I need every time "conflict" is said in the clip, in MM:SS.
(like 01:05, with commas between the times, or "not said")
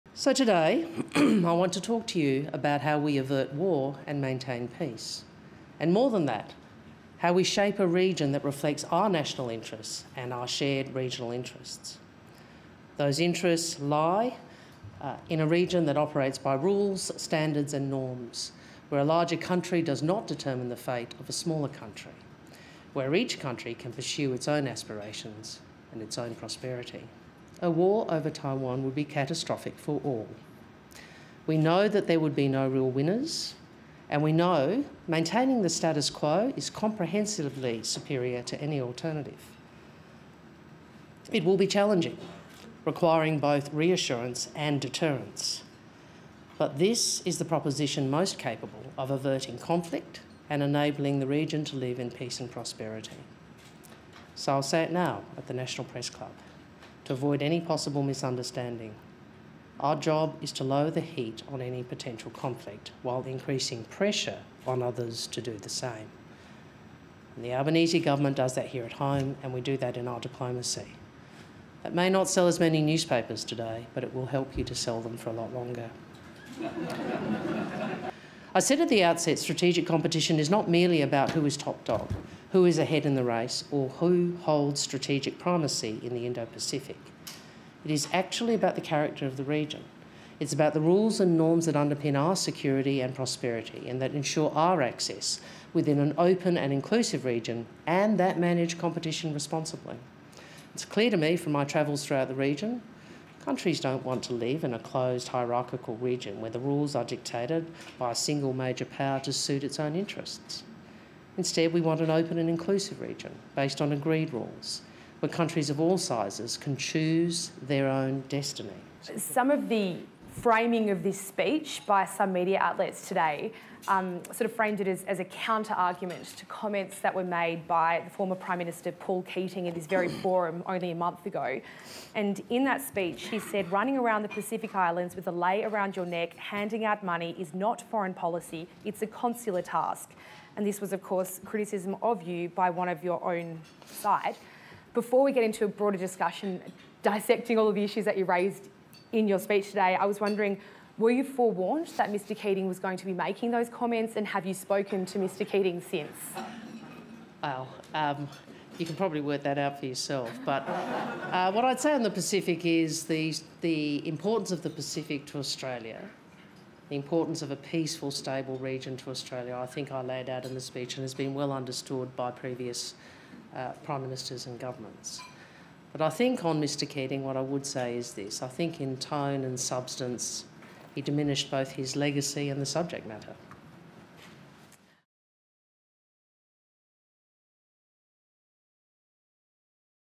00:49, 01:02.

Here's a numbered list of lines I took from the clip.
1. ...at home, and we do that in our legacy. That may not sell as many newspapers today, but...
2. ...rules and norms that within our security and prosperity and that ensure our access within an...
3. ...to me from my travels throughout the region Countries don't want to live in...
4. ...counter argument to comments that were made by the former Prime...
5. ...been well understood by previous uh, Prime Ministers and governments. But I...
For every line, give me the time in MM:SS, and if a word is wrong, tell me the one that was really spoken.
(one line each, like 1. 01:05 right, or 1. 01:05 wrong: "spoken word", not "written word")
1. 01:08 wrong: "diplomacy", not "legacy"
2. 01:30 wrong: "underpin", not "within"
3. 01:41 right
4. 02:05 right
5. 02:51 right.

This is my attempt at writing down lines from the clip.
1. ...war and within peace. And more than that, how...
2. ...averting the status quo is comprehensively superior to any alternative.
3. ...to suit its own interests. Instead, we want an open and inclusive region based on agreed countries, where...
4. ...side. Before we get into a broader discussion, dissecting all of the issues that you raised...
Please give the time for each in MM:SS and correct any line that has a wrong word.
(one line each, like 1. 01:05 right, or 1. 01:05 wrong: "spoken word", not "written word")
1. 00:03 wrong: "maintain", not "within"
2. 00:35 wrong: "maintaining", not "averting"
3. 01:49 wrong: "rules", not "countries"
4. 02:23 right.